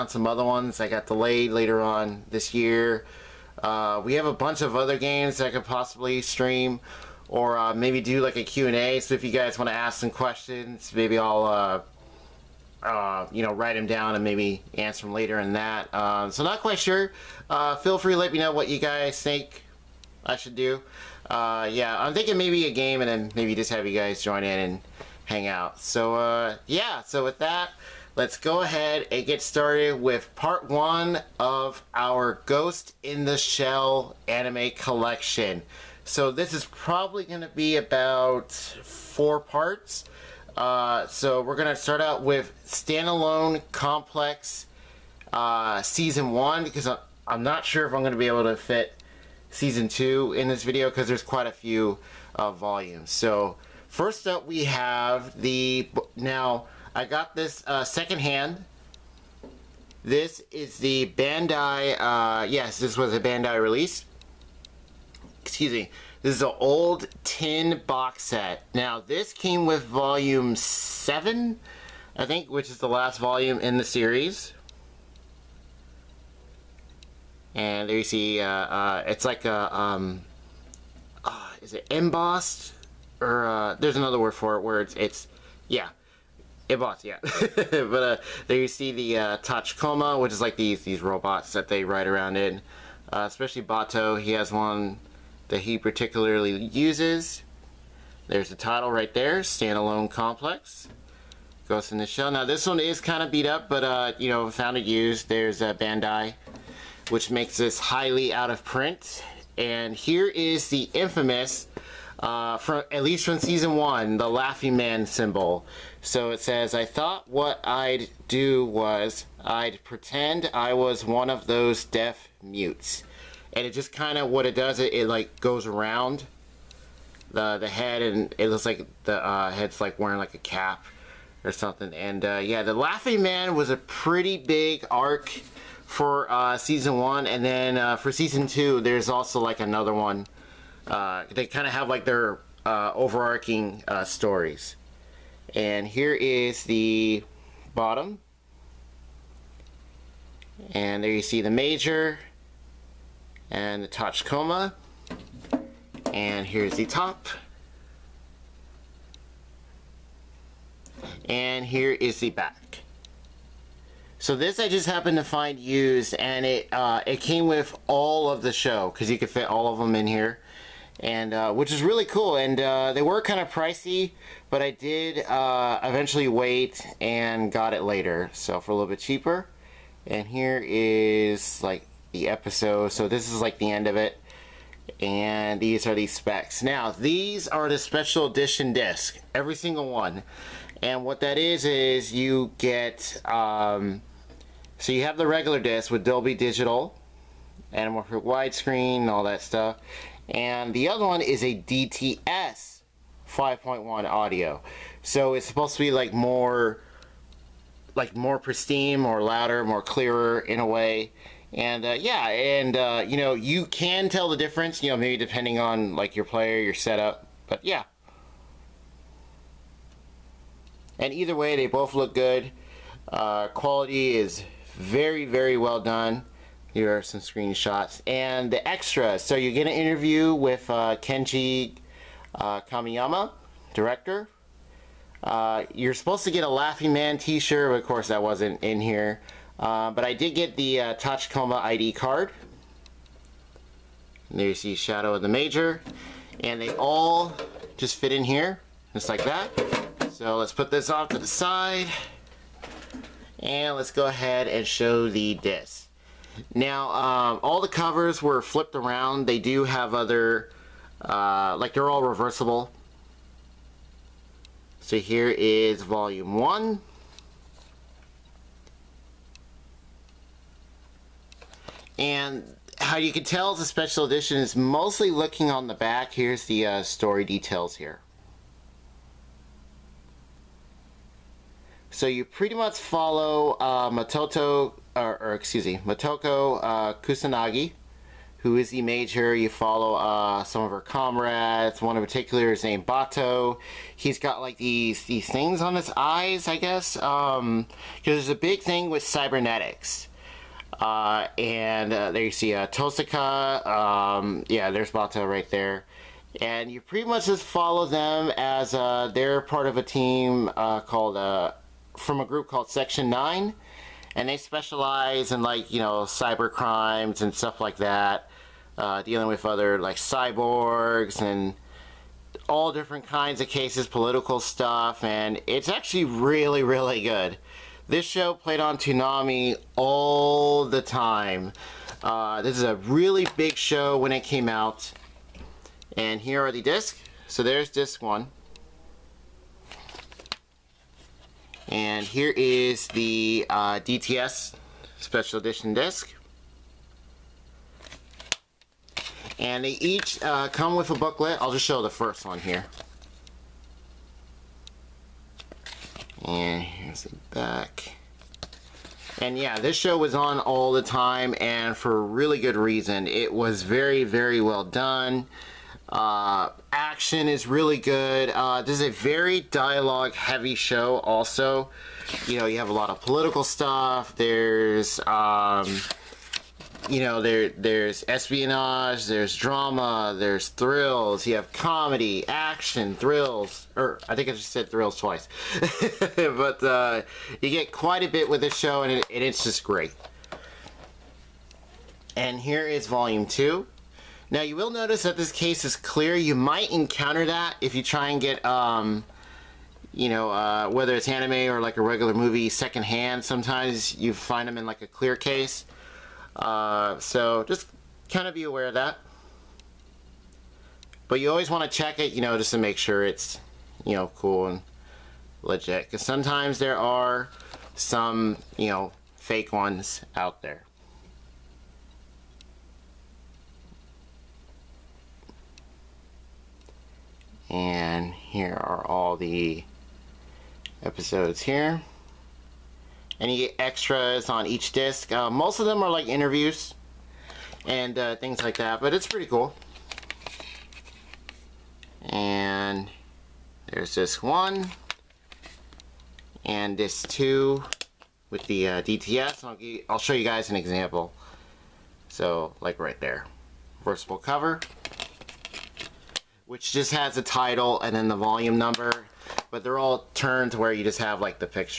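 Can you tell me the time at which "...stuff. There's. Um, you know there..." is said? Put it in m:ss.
6:13.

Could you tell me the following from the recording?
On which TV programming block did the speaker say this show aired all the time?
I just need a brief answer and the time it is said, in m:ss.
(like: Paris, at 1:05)
Toonami, at 5:28.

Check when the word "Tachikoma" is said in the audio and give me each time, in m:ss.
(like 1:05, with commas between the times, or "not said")
1:29, 2:33, 4:00.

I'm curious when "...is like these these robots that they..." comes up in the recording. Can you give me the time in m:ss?
1:30.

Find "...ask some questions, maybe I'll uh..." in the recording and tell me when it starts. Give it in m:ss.
0:09.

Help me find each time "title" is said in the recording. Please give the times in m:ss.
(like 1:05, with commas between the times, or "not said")
1:38, 7:37.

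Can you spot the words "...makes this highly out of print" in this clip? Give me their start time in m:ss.
1:47.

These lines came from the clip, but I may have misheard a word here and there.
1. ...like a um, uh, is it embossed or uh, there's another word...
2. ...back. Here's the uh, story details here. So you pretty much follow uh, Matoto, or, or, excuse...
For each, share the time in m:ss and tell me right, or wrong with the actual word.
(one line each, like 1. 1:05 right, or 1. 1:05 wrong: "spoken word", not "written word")
1. 1:19 right
2. 4:35 right.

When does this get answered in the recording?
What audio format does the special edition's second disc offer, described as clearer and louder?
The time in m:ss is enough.
3:21.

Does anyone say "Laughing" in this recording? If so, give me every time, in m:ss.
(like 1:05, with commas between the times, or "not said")
1:54, 2:12, 3:56.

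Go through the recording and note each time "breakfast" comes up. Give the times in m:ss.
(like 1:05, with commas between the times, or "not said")
not said.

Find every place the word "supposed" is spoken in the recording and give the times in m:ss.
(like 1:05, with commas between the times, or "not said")
3:25, 3:55.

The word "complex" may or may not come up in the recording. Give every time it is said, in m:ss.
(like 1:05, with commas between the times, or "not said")
0:43, 1:40.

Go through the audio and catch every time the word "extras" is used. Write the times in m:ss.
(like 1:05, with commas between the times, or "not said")
3:48, 7:13.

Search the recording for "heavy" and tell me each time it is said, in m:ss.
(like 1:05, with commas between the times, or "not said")
6:10.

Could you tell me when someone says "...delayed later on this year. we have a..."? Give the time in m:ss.
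0:01.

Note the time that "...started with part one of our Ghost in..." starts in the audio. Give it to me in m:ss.
0:29.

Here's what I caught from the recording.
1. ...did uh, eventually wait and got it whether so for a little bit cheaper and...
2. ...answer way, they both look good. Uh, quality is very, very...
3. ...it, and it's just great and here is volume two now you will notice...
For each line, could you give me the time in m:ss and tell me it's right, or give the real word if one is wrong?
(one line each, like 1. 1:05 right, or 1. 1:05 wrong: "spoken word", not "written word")
1. 2:54 wrong: "later", not "whether"
2. 3:41 wrong: "either", not "answer"
3. 6:28 right.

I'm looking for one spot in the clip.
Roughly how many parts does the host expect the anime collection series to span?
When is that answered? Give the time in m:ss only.
0:37.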